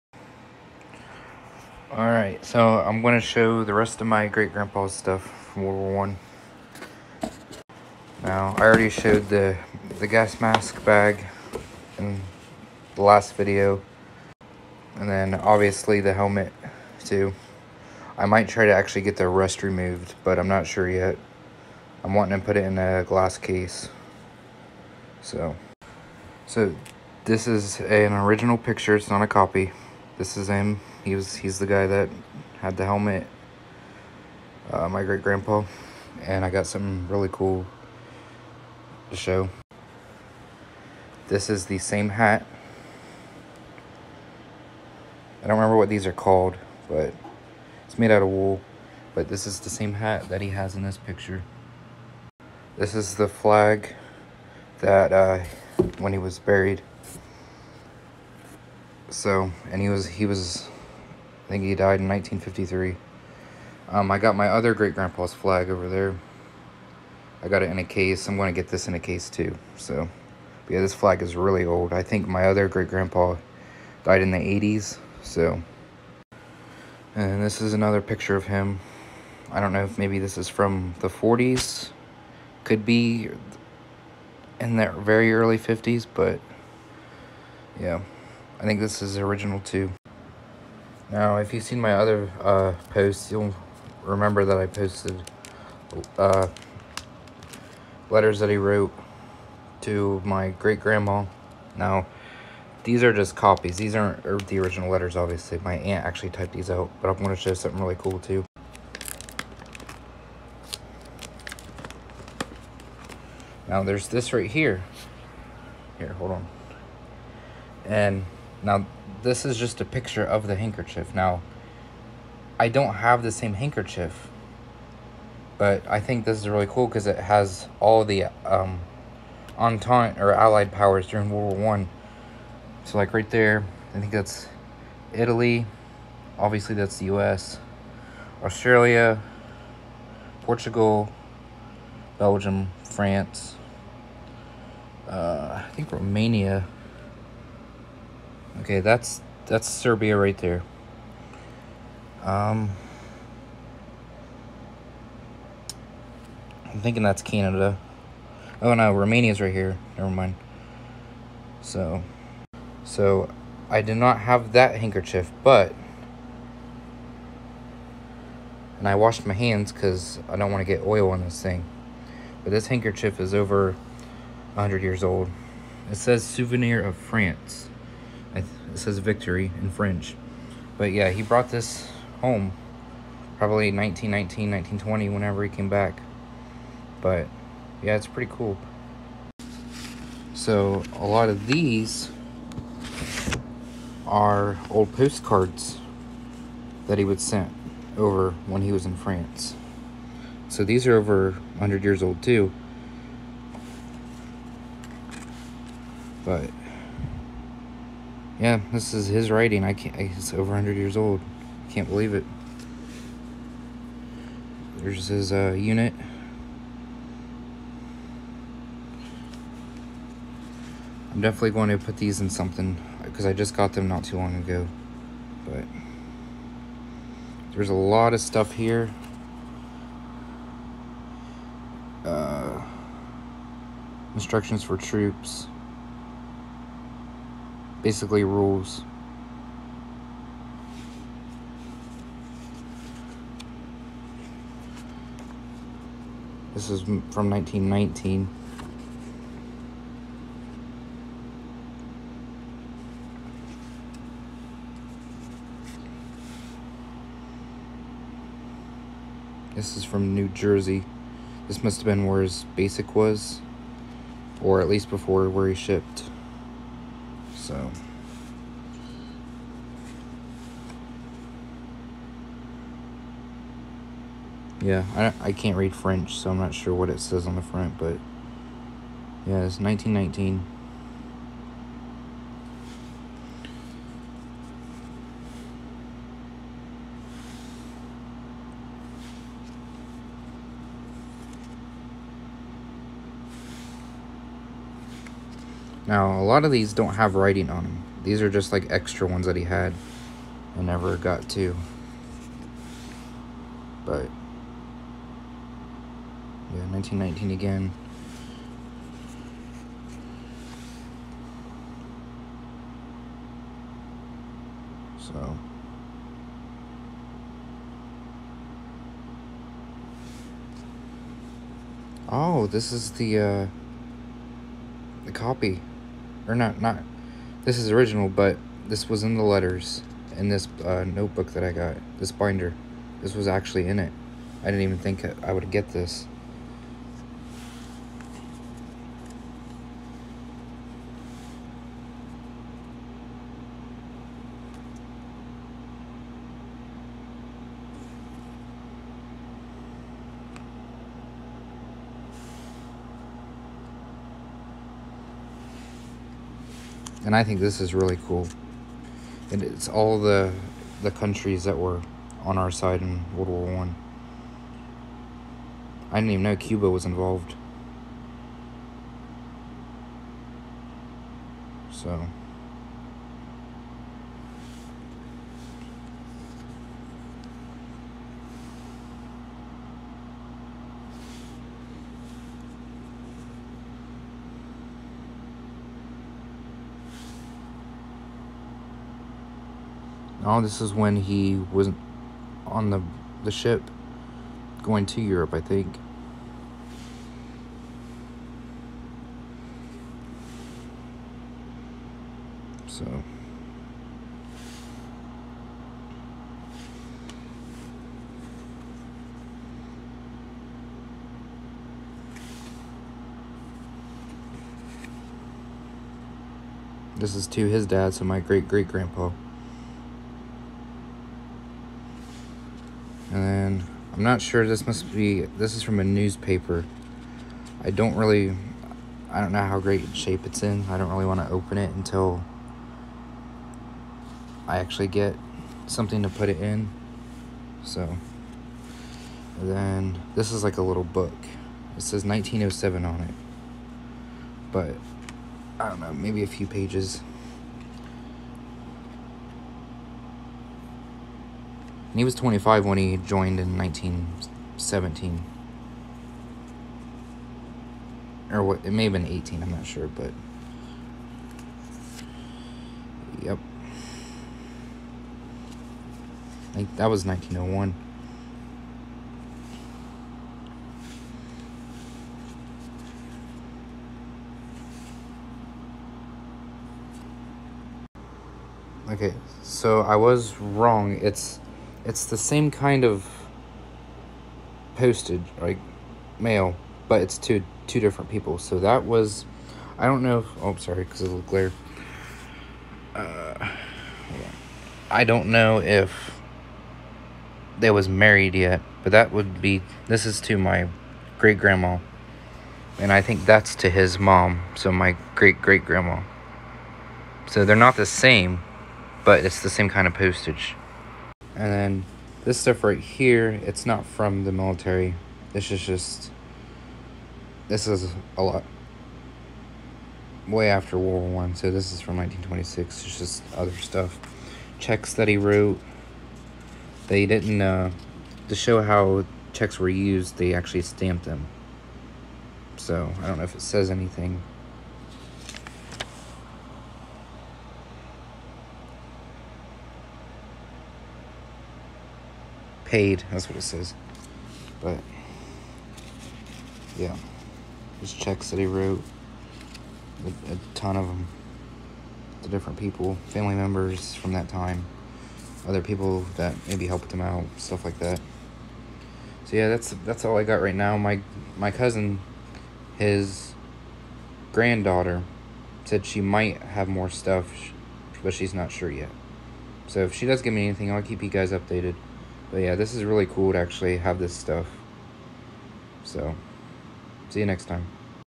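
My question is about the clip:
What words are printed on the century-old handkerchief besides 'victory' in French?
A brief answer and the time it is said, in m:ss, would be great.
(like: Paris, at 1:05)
Souvenir of France, at 2:56.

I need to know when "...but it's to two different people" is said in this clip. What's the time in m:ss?
8:06.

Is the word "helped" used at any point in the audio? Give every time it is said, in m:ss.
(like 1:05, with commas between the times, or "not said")
9:16.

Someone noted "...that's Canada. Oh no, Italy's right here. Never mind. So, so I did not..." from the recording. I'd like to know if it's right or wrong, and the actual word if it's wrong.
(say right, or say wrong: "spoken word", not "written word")
wrong: "Romania", not "Italy".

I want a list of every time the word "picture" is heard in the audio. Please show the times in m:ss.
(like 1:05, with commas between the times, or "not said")
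0:28, 0:50, 1:18, 1:59.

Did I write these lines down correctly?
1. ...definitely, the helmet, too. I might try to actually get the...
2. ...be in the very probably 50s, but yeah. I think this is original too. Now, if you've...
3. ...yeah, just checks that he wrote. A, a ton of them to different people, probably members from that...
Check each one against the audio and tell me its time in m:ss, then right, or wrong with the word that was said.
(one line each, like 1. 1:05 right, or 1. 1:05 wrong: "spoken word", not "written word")
1. 0:15 wrong: "obviously", not "definitely"
2. 1:22 wrong: "early", not "probably"
3. 9:06 wrong: "family", not "probably".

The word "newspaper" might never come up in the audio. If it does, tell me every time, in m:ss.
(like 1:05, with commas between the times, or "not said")
7:05.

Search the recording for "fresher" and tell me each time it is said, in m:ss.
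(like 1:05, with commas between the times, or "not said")
not said.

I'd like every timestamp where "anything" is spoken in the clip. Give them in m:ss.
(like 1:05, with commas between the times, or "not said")
8:53, 9:30.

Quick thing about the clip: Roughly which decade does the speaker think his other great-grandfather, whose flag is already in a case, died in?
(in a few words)
The 80s.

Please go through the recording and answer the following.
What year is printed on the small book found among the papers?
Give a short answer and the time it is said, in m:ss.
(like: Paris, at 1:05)
1907, at 7:22.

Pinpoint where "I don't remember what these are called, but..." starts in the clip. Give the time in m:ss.
0:45.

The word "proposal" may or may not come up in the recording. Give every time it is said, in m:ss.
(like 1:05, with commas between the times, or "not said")
not said.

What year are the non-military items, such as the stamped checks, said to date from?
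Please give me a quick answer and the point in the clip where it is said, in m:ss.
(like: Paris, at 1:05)
1926, at 8:41.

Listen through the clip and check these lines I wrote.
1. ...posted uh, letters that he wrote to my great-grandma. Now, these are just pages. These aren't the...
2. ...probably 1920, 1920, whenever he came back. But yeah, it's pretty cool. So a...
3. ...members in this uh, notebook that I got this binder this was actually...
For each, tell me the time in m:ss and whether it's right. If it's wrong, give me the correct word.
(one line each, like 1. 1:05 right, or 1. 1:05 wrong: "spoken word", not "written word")
1. 1:34 wrong: "copies", not "pages"
2. 3:03 wrong: "1919", not "1920"
3. 5:29 wrong: "letters", not "members".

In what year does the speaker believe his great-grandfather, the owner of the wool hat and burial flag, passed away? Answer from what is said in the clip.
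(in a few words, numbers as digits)
1953.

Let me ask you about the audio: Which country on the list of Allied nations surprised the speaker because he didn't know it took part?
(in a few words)
Cuba.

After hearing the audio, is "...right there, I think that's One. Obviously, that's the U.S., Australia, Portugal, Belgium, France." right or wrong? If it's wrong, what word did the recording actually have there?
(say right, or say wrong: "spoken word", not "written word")
wrong: "Italy", not "One".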